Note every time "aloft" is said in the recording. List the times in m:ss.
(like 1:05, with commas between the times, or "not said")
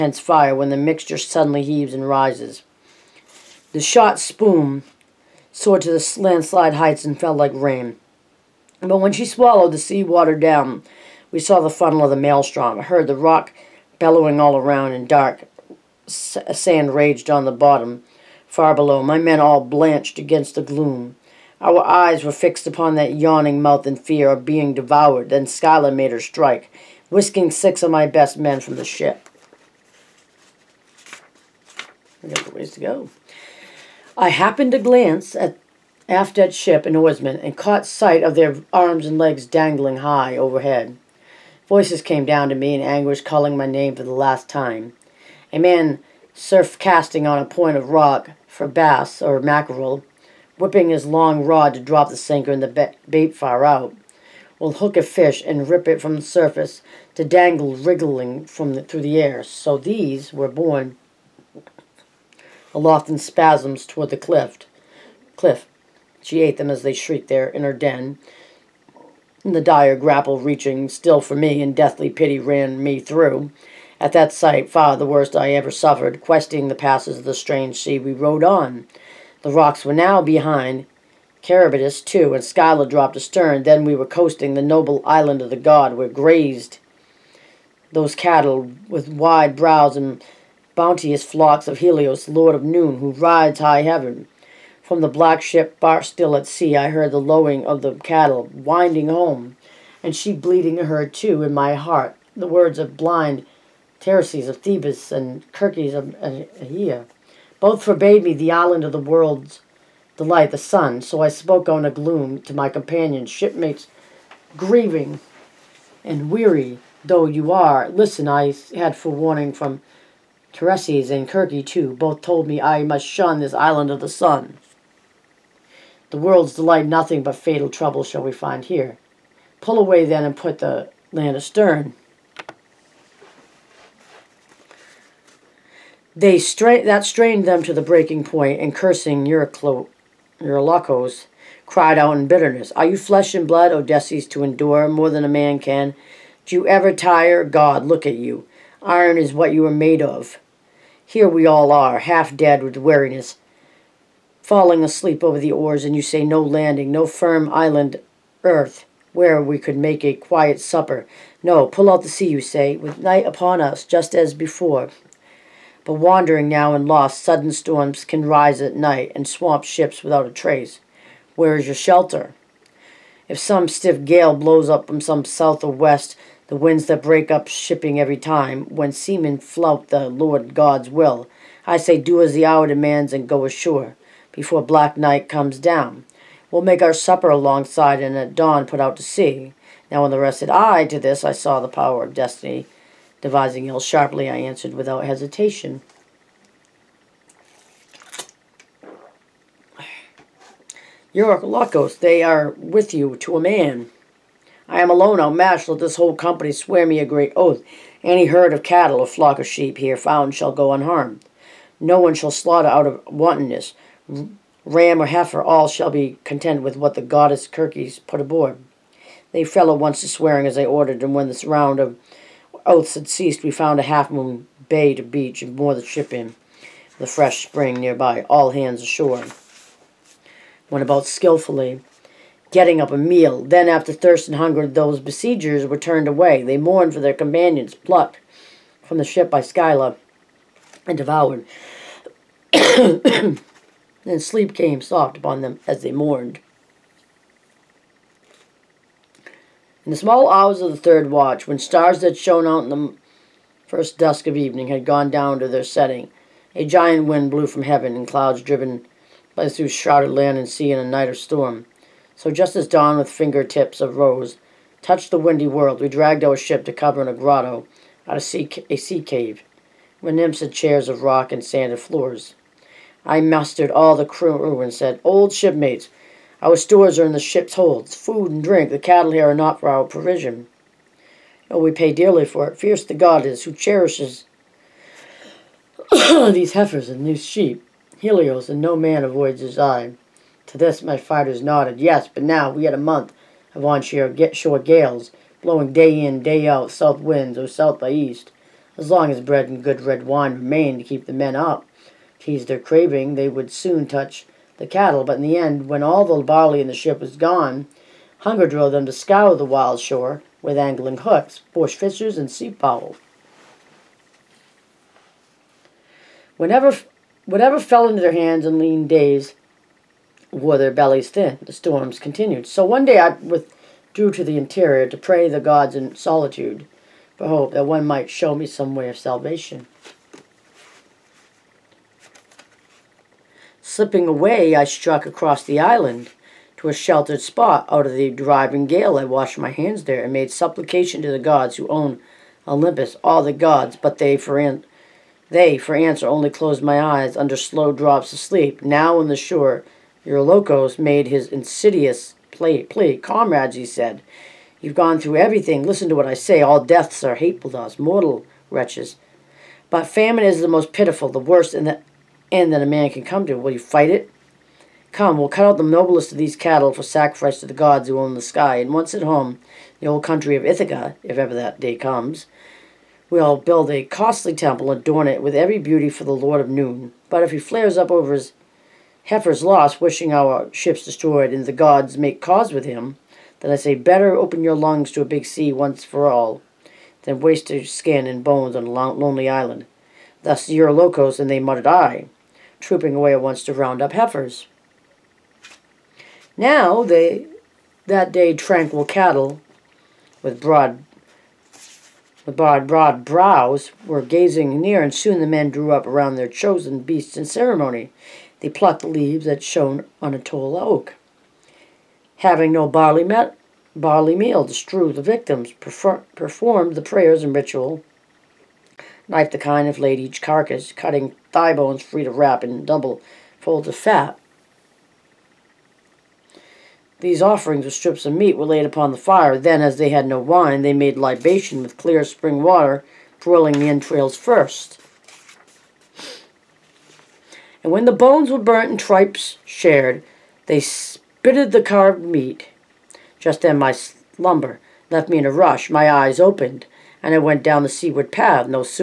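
1:02.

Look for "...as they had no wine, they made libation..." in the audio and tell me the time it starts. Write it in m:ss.
7:09.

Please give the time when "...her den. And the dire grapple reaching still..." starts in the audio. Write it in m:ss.
1:07.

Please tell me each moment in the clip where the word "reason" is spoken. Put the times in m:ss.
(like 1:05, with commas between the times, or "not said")
not said.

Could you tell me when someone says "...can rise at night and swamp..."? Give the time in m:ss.
2:48.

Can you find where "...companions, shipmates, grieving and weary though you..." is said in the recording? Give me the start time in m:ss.
1:52.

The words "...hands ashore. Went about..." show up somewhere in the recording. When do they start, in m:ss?
3:48.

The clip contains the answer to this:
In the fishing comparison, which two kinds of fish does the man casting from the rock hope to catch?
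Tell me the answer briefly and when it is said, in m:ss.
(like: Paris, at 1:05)
Bass or mackerel, at 0:48.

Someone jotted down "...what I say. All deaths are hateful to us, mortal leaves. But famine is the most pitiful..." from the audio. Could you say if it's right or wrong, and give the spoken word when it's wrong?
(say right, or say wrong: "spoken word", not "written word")
wrong: "wretches", not "leaves".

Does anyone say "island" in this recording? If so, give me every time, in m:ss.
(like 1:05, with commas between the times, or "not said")
1:25, 1:48, 2:03, 2:37, 5:35, 6:29.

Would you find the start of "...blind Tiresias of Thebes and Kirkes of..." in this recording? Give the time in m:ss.
1:42.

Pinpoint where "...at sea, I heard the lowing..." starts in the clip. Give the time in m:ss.
1:36.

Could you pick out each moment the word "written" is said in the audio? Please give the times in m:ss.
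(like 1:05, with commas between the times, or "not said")
not said.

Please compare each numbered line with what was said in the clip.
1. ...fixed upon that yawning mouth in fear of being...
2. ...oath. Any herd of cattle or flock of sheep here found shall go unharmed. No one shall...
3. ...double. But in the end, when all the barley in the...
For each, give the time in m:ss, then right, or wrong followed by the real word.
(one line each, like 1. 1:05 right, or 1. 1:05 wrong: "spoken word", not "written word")
1. 0:22 right
2. 3:27 right
3. 5:04 wrong: "cattle", not "double".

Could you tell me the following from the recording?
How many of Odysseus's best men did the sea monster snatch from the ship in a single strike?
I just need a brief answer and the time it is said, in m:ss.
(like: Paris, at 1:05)
6, at 0:27.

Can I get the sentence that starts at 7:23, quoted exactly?
Just then my slumber left me in a rush.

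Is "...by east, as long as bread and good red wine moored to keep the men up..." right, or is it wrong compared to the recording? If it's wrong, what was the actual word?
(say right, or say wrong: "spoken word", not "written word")
wrong: "remained", not "moored".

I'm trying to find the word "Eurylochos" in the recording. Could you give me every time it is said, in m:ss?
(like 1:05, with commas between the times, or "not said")
3:21, 5:50, 6:30.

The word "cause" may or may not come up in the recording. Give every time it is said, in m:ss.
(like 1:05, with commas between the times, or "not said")
6:22.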